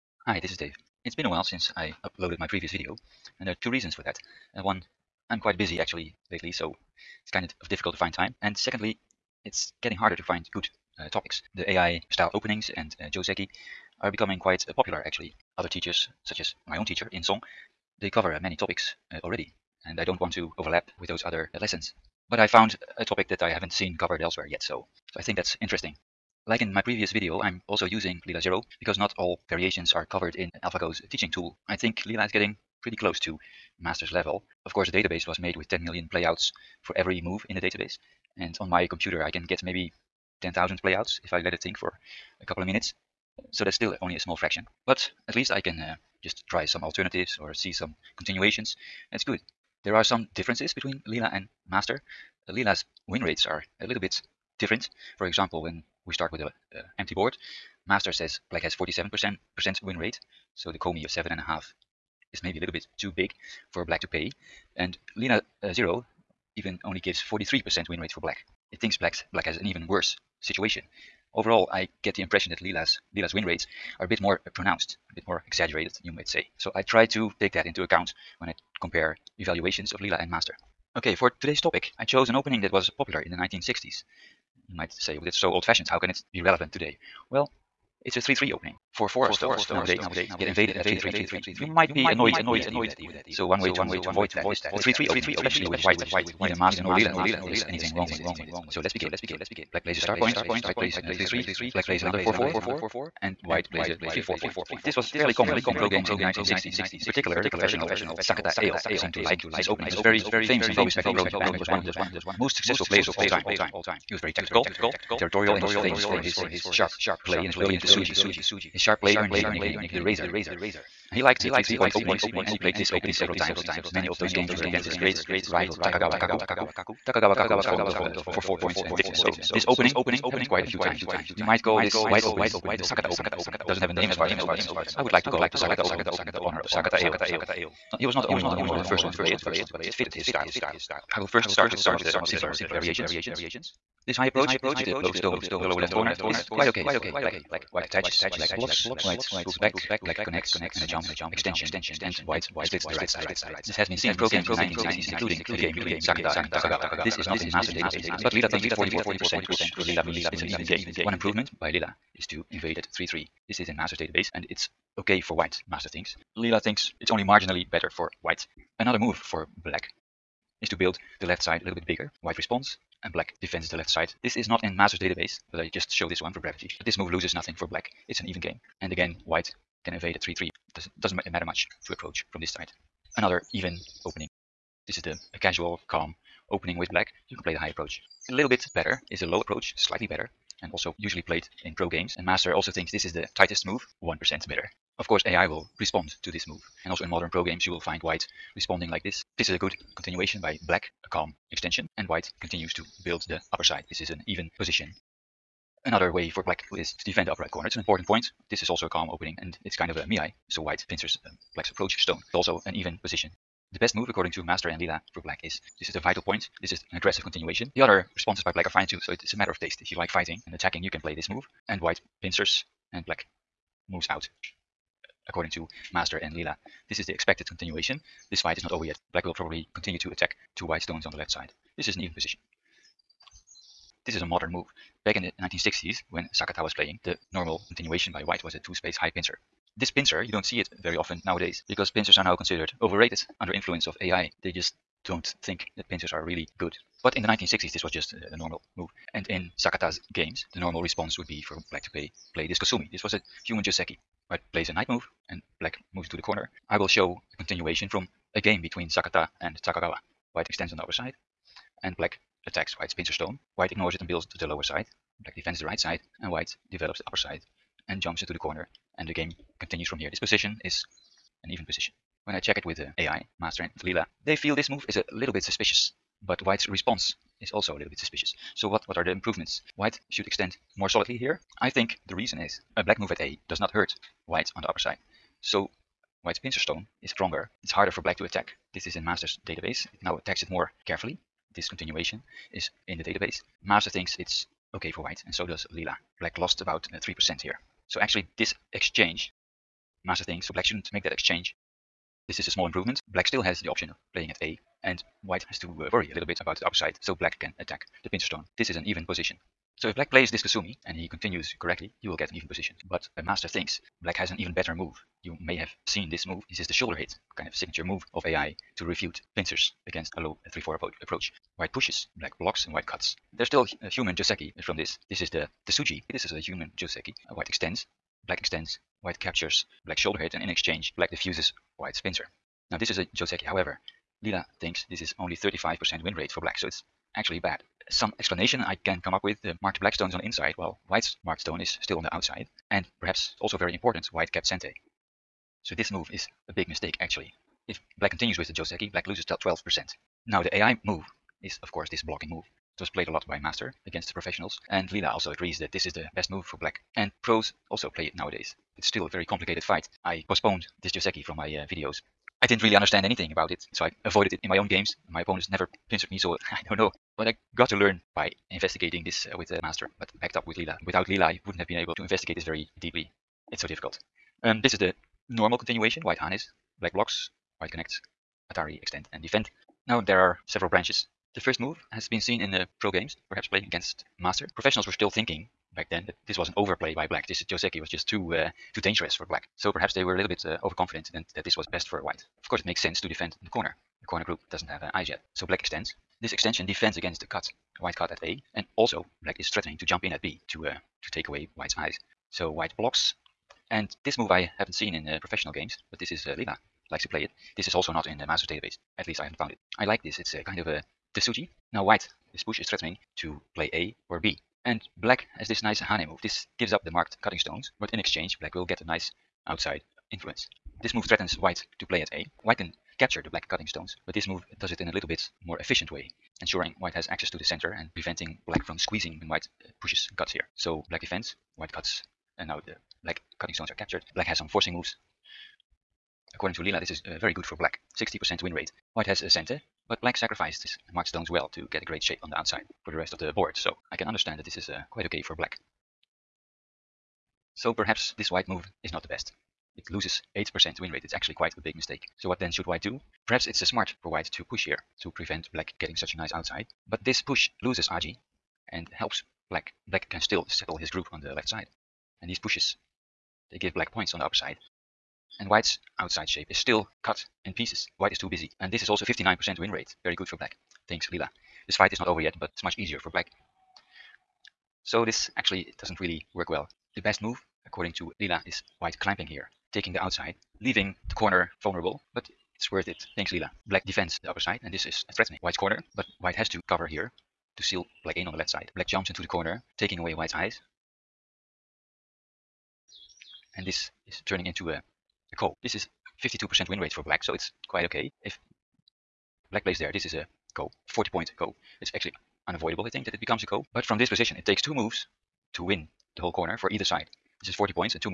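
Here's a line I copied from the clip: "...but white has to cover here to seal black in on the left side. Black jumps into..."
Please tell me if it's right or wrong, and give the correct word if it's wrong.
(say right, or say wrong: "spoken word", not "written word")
right.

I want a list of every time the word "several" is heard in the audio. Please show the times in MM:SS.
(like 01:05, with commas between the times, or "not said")
02:03, 06:20.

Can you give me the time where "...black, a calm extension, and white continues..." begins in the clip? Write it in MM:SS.
03:20.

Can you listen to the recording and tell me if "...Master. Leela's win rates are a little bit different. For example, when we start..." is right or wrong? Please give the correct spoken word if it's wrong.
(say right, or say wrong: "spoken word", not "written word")
right.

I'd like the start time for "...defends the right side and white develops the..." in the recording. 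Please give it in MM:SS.
04:25.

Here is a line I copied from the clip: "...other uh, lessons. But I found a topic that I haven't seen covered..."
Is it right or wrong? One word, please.
right.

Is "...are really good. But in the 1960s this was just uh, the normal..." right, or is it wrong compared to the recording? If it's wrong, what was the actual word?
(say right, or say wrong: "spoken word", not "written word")
right.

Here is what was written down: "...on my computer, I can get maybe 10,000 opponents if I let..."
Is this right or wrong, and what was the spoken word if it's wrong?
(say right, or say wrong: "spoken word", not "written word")
wrong: "playouts", not "opponents".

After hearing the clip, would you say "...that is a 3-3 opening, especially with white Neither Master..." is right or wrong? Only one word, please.
right.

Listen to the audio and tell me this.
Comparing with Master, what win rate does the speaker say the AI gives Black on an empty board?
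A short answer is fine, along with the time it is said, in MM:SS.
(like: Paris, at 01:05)
43%, at 01:07.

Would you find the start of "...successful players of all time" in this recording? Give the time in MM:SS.
01:52.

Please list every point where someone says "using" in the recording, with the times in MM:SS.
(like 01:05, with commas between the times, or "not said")
00:27.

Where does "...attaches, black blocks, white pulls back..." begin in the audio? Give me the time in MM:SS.
02:27.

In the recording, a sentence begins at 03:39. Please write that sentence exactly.
If you like fighting and attacking, you can play this move.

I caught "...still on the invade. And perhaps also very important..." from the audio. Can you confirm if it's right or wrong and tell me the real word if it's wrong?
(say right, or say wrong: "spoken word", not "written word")
wrong: "outside", not "invade".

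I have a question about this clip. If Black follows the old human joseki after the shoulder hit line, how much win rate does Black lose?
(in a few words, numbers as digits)
12%.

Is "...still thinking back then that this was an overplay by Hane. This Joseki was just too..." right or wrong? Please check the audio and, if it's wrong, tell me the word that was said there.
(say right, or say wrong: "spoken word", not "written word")
wrong: "Black", not "Hane".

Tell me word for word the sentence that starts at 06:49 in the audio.
I like this, it's uh, kind of a uh, Tesuji.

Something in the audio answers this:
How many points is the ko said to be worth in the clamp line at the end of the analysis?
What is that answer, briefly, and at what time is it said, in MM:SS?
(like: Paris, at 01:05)
40, at 08:20.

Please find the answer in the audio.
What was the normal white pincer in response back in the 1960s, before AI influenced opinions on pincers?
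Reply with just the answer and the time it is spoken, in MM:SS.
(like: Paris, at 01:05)
two-space high pincer, at 03:58.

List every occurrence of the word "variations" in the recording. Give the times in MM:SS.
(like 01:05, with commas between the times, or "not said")
00:29, 02:22.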